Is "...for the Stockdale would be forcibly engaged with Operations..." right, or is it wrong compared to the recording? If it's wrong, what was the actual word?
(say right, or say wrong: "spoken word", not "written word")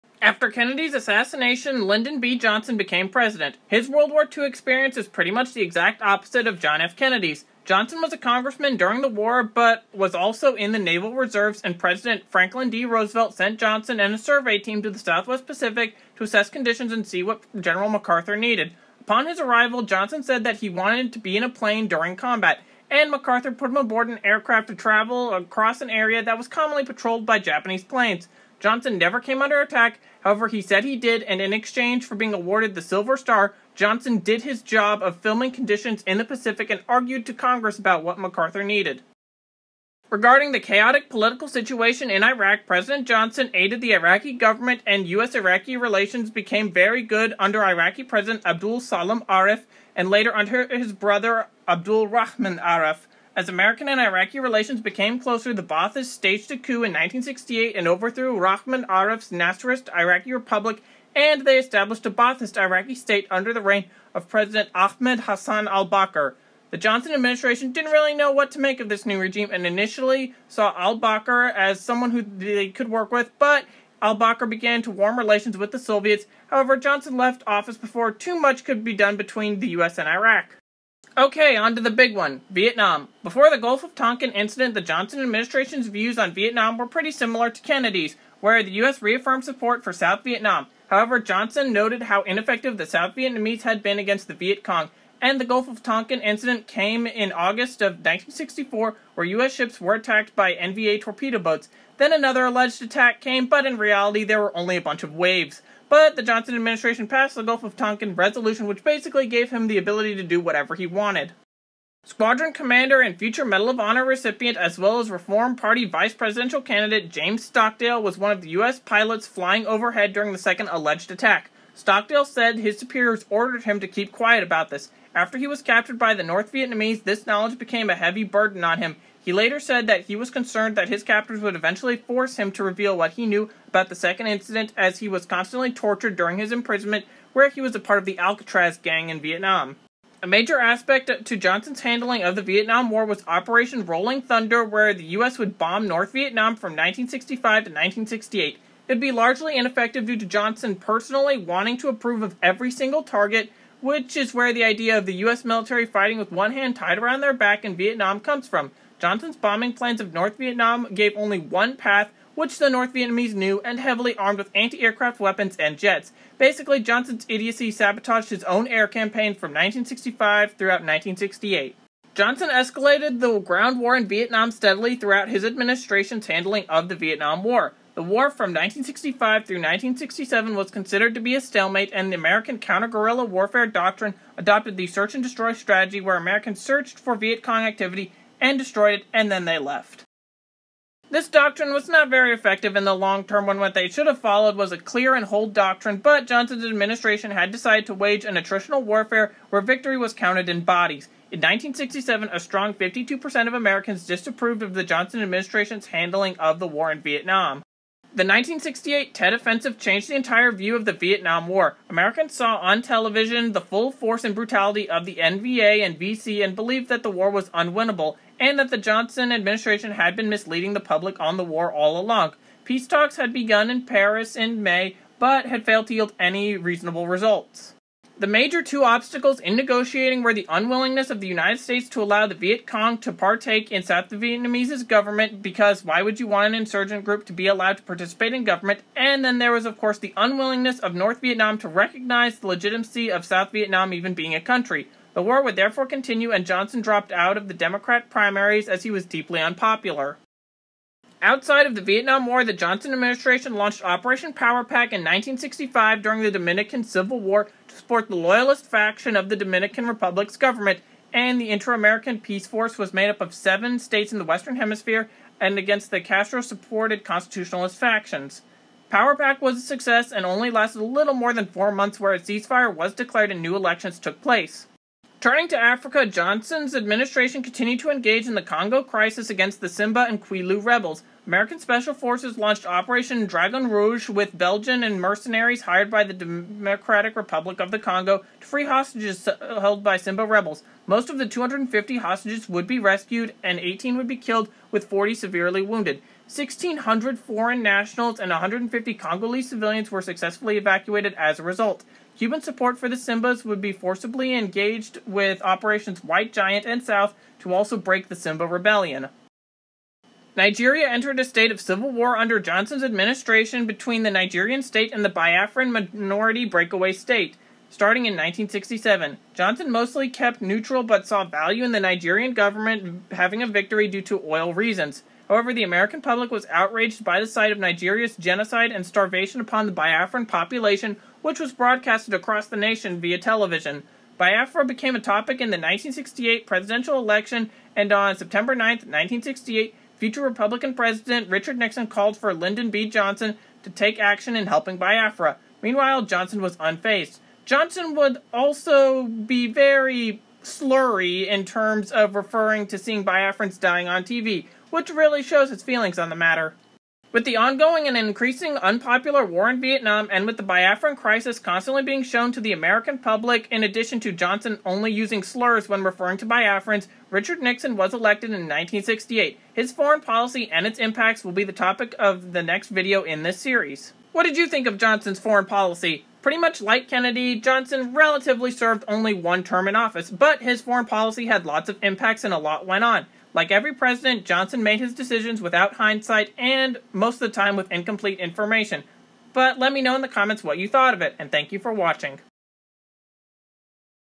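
wrong: "Simbas", not "Stockdale".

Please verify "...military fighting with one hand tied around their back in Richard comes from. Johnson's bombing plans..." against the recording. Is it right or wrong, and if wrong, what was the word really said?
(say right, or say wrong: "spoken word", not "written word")
wrong: "Vietnam", not "Richard".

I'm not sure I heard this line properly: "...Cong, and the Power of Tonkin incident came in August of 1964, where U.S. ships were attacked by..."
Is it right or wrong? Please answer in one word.
wrong.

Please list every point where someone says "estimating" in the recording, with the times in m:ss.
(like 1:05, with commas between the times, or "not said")
not said.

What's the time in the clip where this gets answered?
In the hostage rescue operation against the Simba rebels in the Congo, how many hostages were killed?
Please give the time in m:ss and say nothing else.
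4:53.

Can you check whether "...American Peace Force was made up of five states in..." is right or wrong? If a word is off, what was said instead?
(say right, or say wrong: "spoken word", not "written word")
wrong: "seven", not "five".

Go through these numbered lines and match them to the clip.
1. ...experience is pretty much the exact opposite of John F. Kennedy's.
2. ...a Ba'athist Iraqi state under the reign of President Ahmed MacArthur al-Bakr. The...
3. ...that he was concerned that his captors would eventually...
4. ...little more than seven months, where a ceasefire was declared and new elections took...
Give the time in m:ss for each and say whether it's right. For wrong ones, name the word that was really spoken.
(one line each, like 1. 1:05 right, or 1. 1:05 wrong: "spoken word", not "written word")
1. 0:04 right
2. 1:02 wrong: "Hassan", not "MacArthur"
3. 2:09 right
4. 4:30 wrong: "four", not "seven".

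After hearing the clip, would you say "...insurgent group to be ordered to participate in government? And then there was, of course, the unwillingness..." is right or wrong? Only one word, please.
wrong.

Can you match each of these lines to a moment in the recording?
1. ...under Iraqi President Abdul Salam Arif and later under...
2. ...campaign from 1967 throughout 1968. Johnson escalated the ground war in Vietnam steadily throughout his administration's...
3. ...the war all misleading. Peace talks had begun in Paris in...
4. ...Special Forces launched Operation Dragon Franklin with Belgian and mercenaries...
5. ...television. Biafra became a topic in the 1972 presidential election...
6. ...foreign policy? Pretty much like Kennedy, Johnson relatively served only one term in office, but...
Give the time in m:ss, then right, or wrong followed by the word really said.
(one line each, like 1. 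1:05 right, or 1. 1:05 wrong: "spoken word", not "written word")
1. 0:47 right
2. 2:48 wrong: "1965", not "1967"
3. 3:41 wrong: "along", not "misleading"
4. 4:41 wrong: "Rouge", not "Franklin"
5. 5:33 wrong: "1968", not "1972"
6. 6:15 right.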